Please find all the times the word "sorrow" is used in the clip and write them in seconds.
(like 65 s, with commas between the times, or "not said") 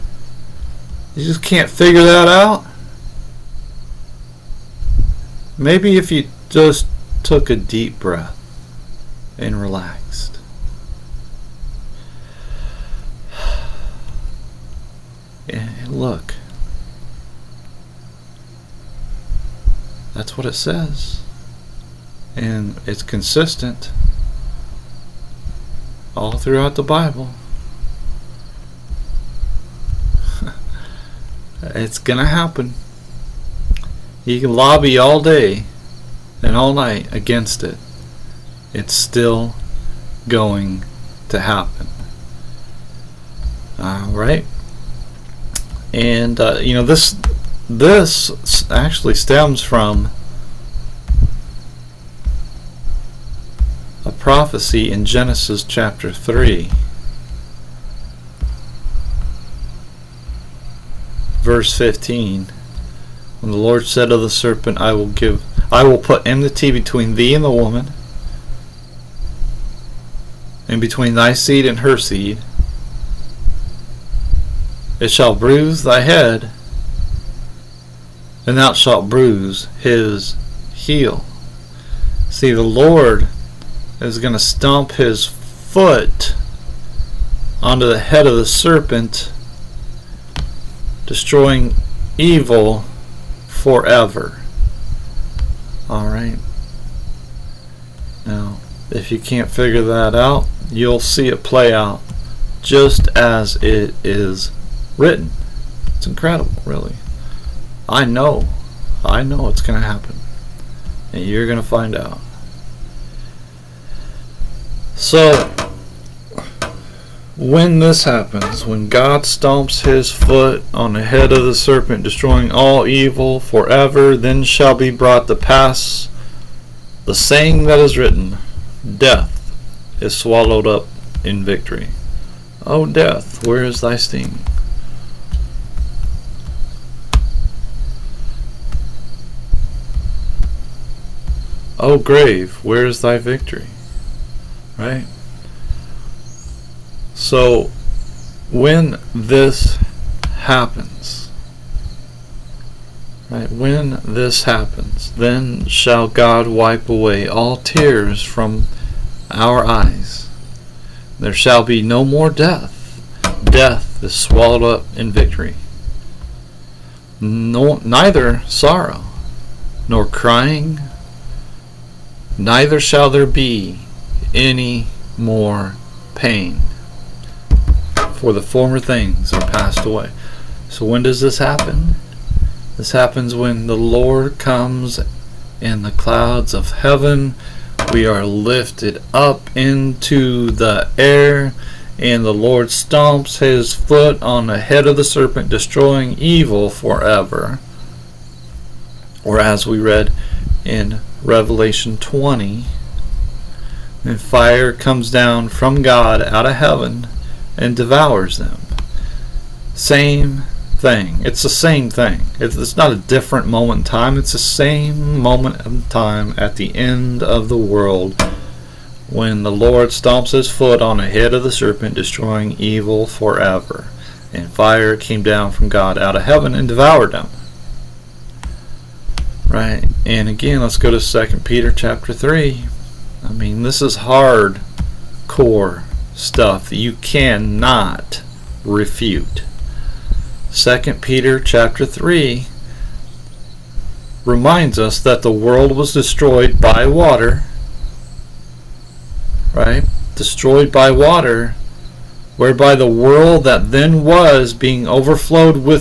168 s.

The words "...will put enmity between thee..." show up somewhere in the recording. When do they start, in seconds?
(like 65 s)
65 s.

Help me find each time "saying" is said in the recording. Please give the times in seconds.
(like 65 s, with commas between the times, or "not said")
127 s.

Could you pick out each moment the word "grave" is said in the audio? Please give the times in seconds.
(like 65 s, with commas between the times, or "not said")
141 s.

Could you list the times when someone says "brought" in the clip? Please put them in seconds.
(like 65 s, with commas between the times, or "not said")
124 s.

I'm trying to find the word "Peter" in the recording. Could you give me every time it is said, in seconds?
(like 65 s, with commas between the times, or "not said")
231 s, 241 s.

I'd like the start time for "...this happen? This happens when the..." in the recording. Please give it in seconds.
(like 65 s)
181 s.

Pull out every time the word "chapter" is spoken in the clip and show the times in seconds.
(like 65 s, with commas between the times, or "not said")
55 s, 231 s, 241 s.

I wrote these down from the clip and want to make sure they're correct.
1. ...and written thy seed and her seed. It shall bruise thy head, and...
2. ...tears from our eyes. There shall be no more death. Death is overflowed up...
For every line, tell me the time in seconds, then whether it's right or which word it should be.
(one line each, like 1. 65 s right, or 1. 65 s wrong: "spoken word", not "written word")
1. 70 s wrong: "between", not "written"
2. 157 s wrong: "swallowed", not "overflowed".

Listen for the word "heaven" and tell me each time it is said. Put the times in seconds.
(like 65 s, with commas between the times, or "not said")
186 s, 206 s, 226 s.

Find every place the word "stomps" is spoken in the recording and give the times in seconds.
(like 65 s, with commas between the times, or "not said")
84 s, 119 s, 192 s, 219 s.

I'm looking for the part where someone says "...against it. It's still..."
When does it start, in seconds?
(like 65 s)
37 s.